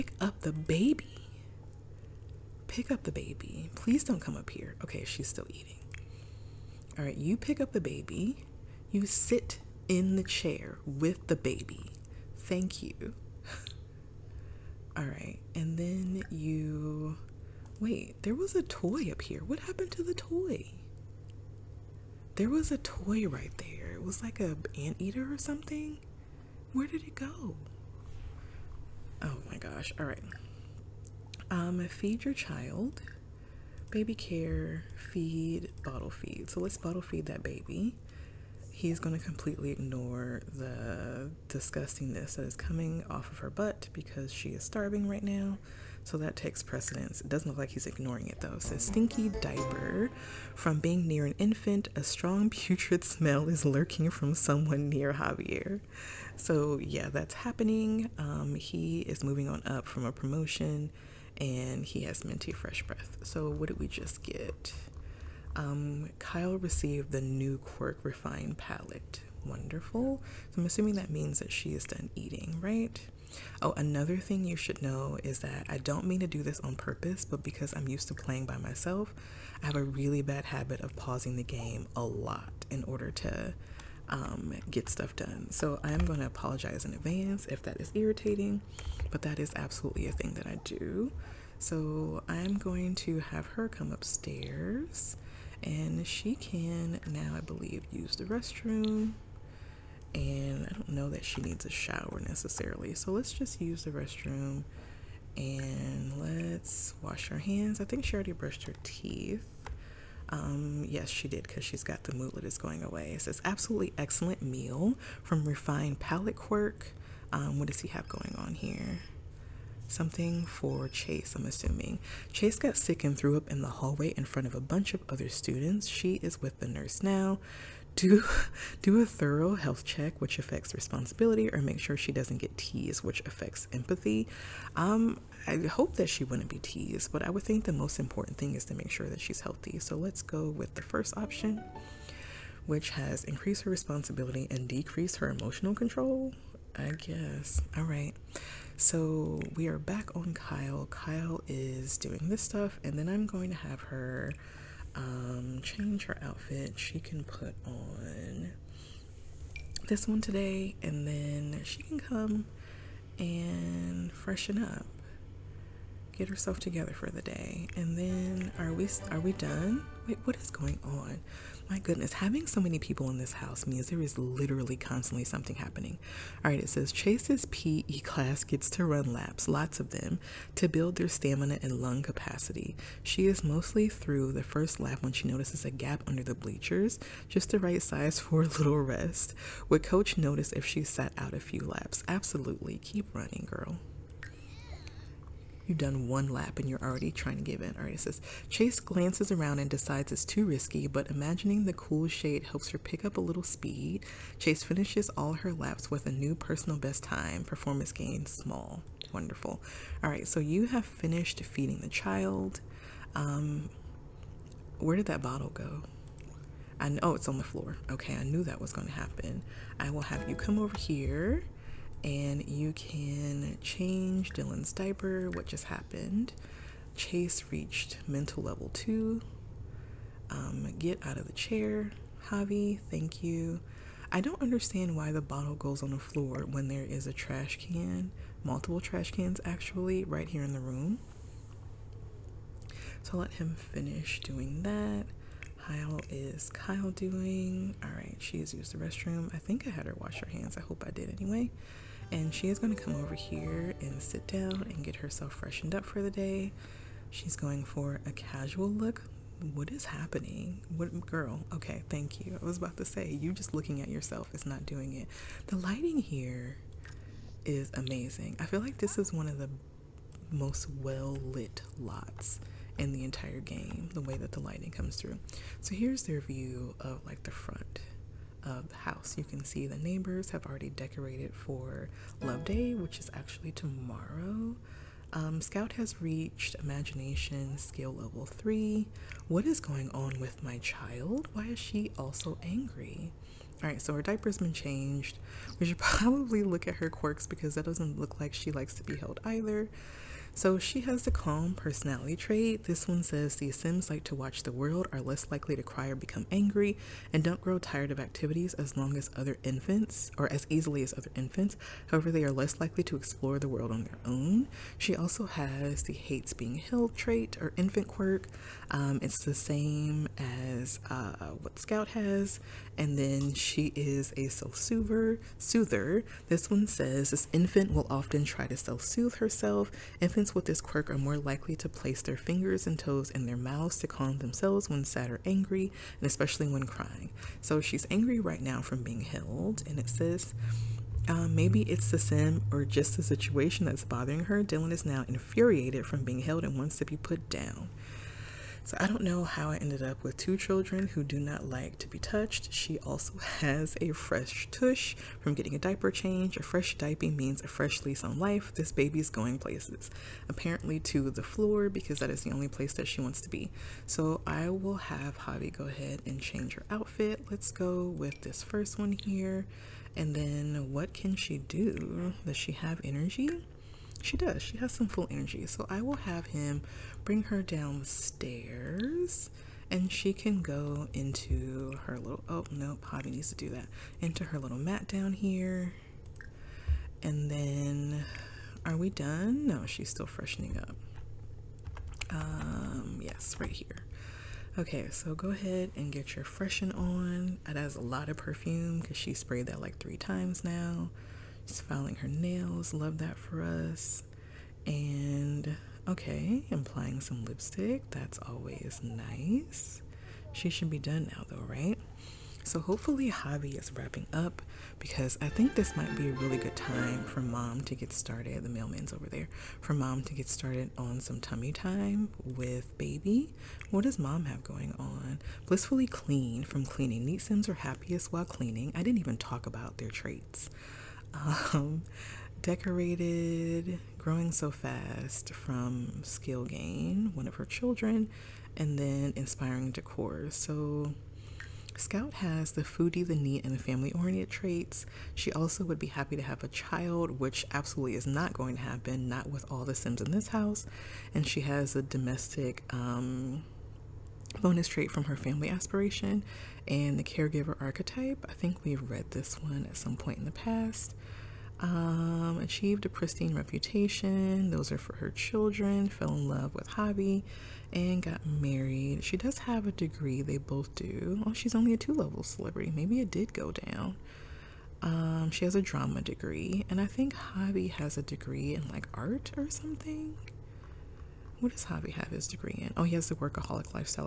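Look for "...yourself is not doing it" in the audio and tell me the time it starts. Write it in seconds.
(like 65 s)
263 s.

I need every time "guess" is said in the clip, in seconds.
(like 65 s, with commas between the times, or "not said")
146 s.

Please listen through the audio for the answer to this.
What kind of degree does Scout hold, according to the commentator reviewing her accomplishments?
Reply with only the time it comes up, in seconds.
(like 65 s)
475 s.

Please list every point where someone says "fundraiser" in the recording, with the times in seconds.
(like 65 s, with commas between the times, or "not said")
not said.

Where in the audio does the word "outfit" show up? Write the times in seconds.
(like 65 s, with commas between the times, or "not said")
156 s, 366 s.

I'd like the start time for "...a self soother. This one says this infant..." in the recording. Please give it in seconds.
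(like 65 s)
324 s.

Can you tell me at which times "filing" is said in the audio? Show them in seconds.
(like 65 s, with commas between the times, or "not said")
401 s.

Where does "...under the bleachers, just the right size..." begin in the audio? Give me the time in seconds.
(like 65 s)
186 s.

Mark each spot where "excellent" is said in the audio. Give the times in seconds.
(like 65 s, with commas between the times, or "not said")
113 s.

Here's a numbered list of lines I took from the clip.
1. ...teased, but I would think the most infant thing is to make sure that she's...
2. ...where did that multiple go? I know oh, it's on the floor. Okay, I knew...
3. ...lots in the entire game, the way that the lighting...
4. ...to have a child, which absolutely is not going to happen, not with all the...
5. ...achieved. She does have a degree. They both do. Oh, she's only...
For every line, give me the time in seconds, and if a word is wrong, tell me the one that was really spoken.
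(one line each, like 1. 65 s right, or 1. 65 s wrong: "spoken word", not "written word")
1. 136 s wrong: "important", not "infant"
2. 214 s wrong: "bottle", not "multiple"
3. 271 s right
4. 446 s right
5. 468 s wrong: "married", not "achieved".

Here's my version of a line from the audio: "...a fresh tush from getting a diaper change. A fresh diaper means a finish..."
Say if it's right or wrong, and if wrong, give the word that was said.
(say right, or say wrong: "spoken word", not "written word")
wrong: "fresh", not "finish".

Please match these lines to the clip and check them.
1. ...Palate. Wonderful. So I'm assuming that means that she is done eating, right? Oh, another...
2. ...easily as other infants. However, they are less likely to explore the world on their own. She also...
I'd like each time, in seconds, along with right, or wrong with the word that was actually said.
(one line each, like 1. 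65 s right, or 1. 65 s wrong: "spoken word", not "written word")
1. 68 s right
2. 310 s right.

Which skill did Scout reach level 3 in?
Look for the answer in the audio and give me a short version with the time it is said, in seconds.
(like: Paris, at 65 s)
Imagination, at 286 s.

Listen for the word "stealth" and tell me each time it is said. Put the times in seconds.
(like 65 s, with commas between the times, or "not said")
not said.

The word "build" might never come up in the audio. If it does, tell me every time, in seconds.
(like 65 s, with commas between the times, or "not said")
180 s.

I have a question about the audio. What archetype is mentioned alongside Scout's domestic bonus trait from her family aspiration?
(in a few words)
Caregiver.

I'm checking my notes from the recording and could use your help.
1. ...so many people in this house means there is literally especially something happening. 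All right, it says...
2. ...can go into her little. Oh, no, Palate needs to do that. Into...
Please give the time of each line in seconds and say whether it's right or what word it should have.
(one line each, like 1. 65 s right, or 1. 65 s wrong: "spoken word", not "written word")
1. 172 s wrong: "constantly", not "especially"
2. 380 s wrong: "Javi", not "Palate".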